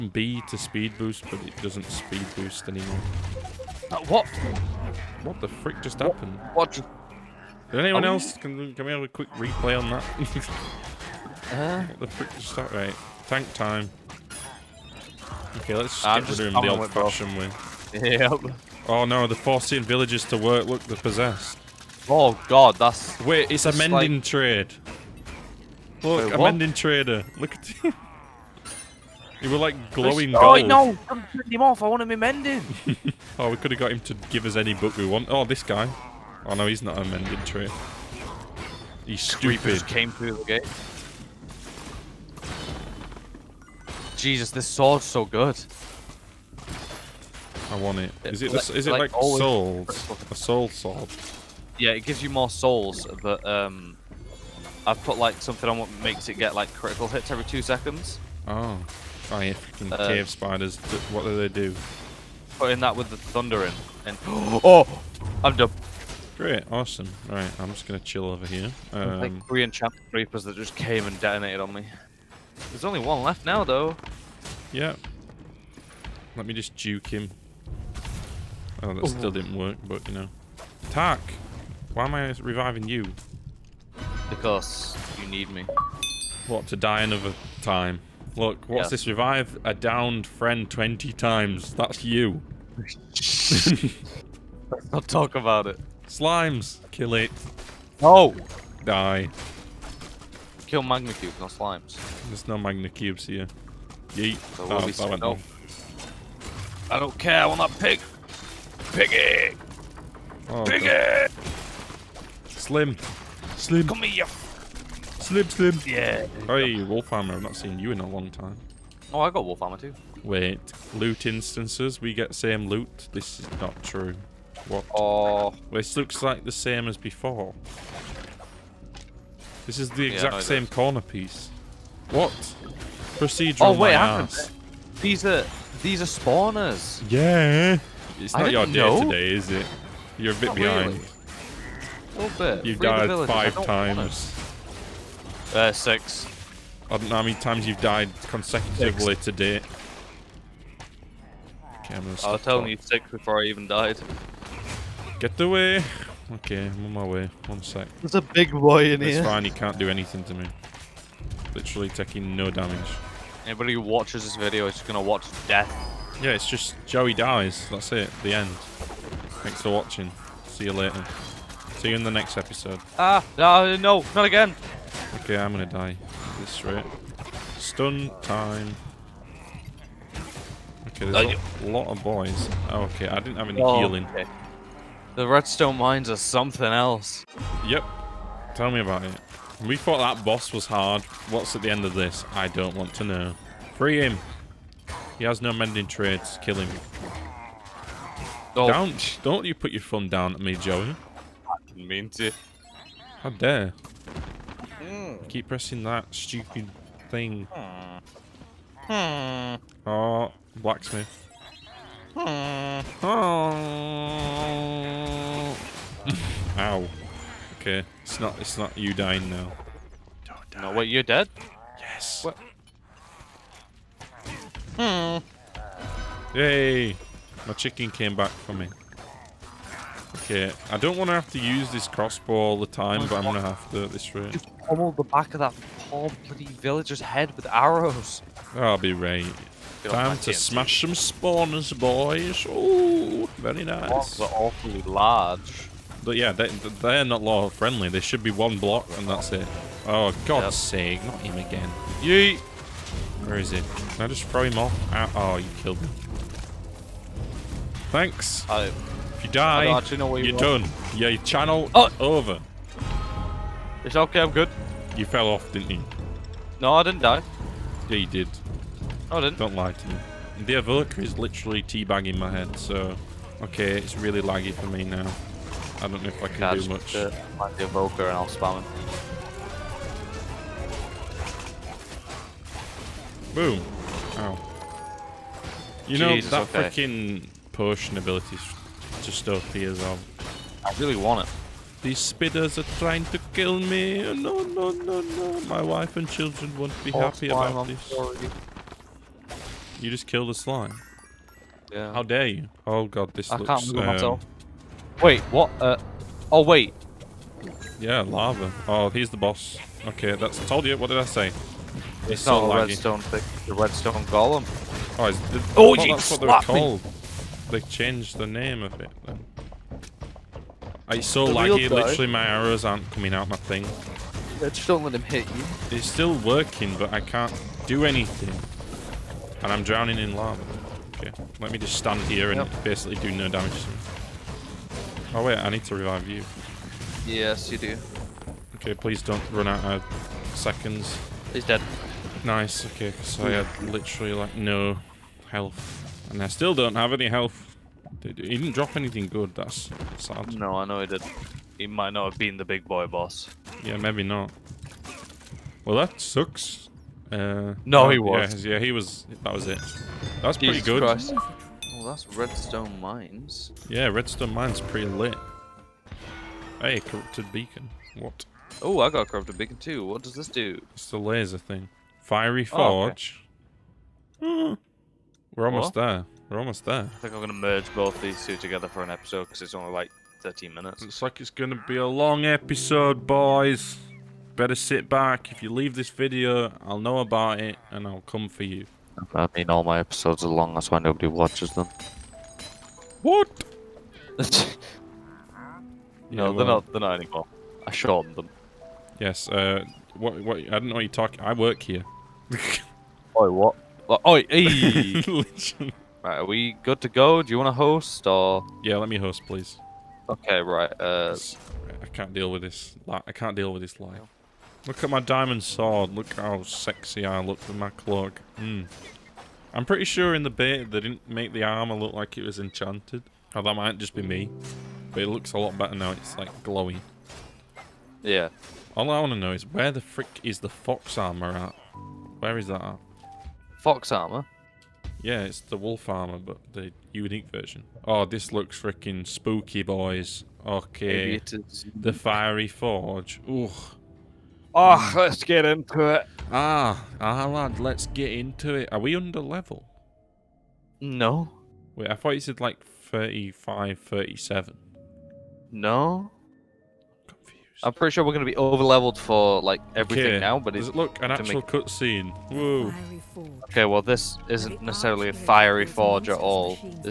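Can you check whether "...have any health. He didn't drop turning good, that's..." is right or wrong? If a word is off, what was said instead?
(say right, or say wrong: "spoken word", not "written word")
wrong: "anything", not "turning".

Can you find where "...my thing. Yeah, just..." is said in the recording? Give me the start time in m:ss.
5:23.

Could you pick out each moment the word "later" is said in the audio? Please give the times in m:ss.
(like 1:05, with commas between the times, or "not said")
2:50.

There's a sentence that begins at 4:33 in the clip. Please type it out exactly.
Okay, it's really laggy for me now.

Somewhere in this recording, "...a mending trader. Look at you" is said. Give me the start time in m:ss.
0:26.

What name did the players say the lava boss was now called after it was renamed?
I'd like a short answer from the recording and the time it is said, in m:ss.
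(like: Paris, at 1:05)
redstone golem, at 5:13.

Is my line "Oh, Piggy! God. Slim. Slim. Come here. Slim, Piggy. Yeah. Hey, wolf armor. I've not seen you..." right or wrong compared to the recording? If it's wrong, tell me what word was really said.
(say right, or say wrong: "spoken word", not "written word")
wrong: "Slim", not "Piggy".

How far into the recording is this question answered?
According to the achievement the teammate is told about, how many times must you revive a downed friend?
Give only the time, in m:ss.
1:30.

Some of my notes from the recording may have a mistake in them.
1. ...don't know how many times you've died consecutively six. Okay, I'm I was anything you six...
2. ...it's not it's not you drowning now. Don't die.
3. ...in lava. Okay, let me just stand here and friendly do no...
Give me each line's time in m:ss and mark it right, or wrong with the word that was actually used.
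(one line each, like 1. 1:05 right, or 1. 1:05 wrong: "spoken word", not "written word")
1. 2:26 wrong: "telling", not "anything"
2. 3:38 wrong: "dying", not "drowning"
3. 5:29 wrong: "basically", not "friendly".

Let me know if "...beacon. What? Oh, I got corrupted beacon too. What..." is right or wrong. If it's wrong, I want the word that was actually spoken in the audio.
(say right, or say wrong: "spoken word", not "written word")
right.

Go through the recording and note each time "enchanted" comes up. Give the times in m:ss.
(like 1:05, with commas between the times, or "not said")
1:09, 7:02.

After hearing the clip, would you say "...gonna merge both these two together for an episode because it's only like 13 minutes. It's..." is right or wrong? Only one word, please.
right.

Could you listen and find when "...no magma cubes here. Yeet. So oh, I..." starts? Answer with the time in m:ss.
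1:42.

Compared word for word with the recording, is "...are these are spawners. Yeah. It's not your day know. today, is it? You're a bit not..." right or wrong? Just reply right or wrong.
right.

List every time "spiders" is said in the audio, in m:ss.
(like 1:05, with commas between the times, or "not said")
1:00, 4:51.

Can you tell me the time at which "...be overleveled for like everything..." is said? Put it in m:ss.
7:38.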